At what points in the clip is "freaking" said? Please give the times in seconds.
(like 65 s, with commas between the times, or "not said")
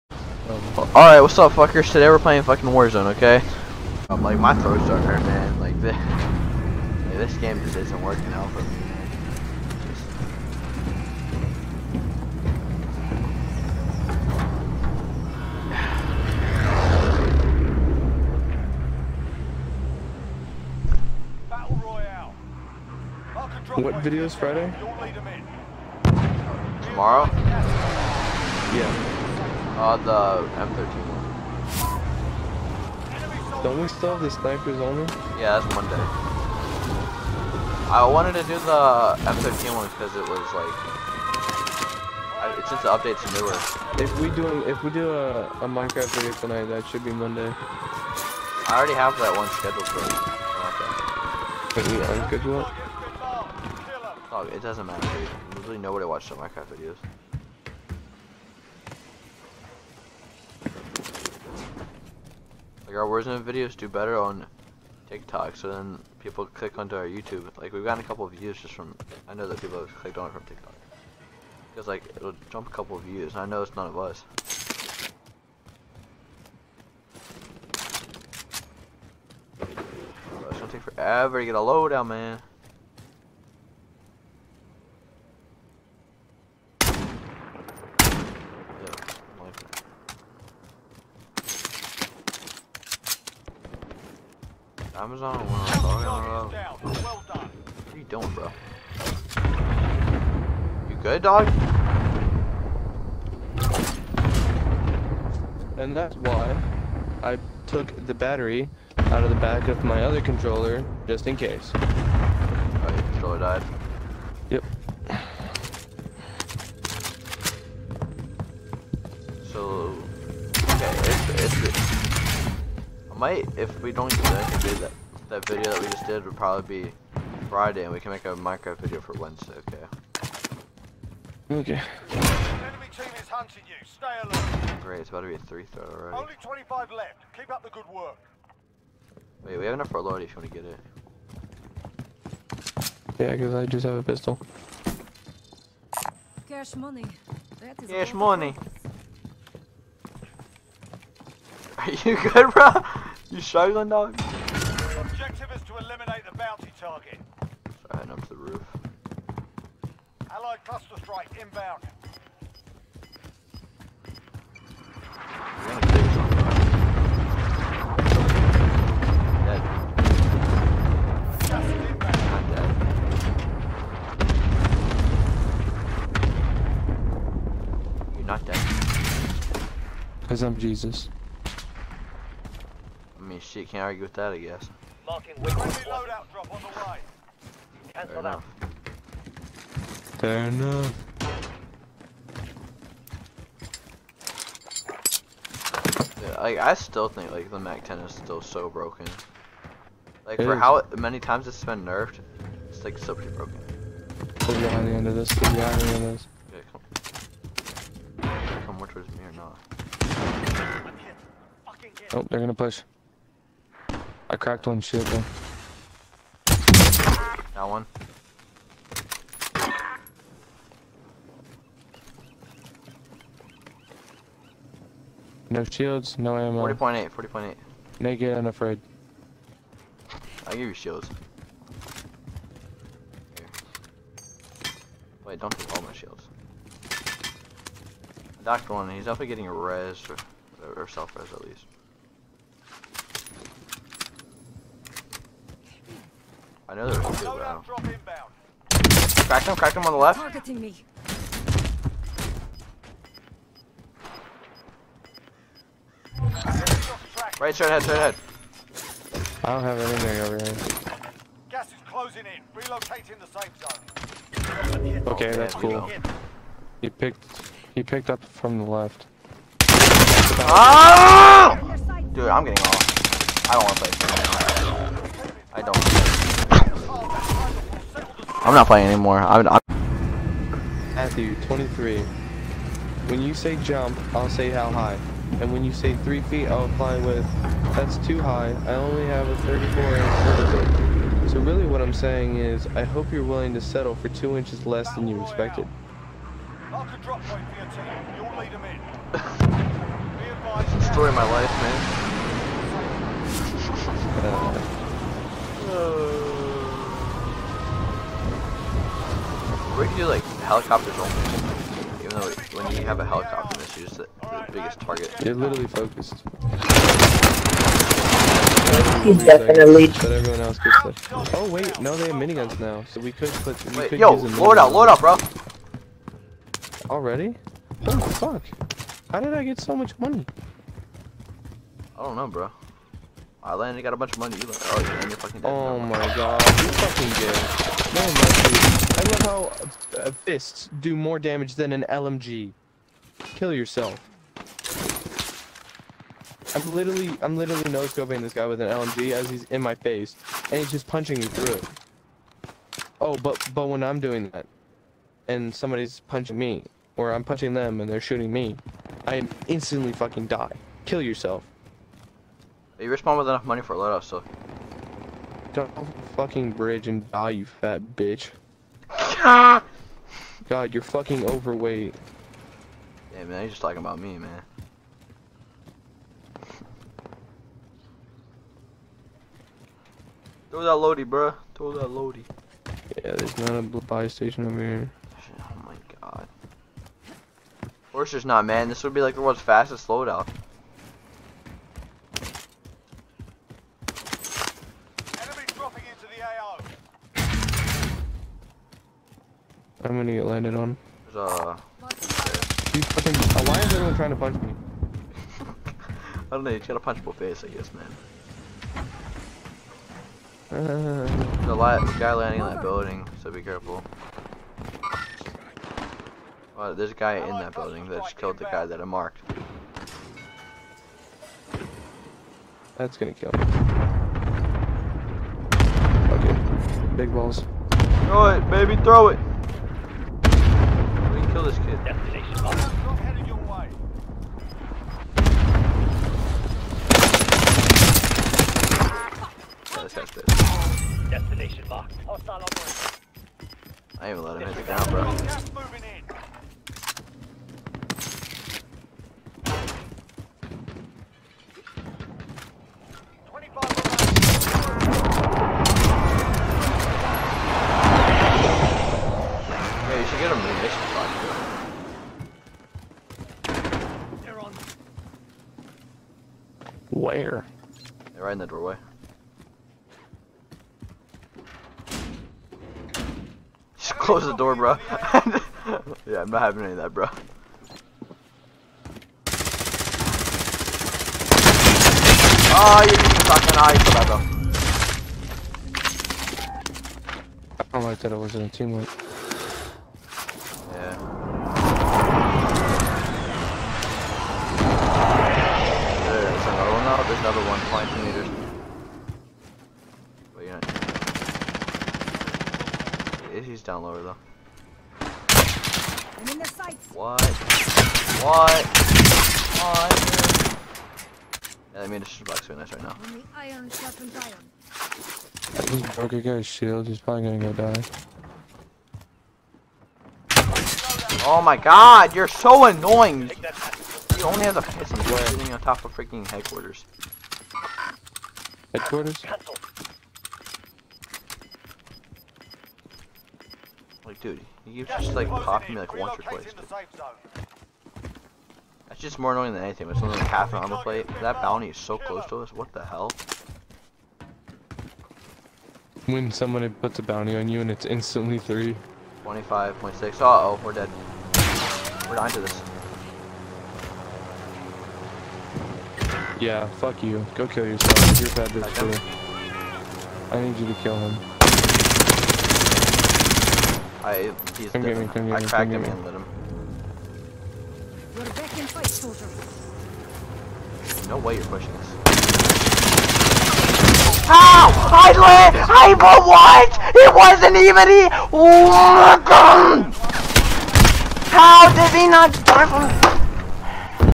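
525 s.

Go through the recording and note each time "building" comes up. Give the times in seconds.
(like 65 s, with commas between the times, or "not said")
412 s, 417 s.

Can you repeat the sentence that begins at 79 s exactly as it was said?
It's gonna take forever to get a loadout, man.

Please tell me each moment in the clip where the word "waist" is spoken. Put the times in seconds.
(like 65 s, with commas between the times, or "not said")
not said.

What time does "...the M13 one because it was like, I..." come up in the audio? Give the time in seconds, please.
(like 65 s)
38 s.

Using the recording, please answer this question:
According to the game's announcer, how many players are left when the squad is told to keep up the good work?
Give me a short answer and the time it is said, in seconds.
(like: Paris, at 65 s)
25, at 136 s.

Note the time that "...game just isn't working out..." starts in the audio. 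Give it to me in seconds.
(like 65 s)
7 s.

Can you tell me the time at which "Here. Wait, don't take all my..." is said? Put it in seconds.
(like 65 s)
233 s.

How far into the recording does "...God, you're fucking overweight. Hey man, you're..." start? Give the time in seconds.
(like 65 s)
369 s.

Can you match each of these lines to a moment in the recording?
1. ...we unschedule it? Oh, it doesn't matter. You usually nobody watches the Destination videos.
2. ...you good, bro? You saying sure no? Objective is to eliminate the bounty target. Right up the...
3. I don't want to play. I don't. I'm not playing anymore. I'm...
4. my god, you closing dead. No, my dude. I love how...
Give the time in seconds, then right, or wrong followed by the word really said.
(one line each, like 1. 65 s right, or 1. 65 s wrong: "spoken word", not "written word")
1. 51 s wrong: "Minecraft", not "Destination"
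2. 152 s wrong: "showing", not "saying"
3. 273 s right
4. 335 s wrong: "fucking", not "closing".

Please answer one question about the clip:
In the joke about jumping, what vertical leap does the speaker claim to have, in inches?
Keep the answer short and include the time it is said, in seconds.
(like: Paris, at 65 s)
34, at 289 s.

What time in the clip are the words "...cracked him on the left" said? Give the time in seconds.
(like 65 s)
249 s.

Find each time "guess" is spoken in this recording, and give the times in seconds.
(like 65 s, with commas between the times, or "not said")
184 s, 407 s.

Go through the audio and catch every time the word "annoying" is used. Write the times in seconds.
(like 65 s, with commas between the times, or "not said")
522 s, 539 s.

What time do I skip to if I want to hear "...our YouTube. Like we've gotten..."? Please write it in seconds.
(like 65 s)
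66 s.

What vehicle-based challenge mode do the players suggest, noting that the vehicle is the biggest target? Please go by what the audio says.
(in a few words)
Helicopters only.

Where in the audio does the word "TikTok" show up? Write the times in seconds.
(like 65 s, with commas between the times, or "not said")
65 s, 70 s.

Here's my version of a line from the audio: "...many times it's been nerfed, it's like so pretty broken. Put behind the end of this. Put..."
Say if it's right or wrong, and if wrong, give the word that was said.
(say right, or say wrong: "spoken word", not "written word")
right.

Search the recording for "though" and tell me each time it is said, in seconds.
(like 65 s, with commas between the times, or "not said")
215 s, 312 s, 504 s.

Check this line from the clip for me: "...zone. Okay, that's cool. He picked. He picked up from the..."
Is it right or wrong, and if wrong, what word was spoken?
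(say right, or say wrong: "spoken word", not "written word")
right.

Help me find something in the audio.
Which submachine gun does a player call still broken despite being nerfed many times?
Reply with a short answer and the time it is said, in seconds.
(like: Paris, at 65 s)
MAC-10, at 197 s.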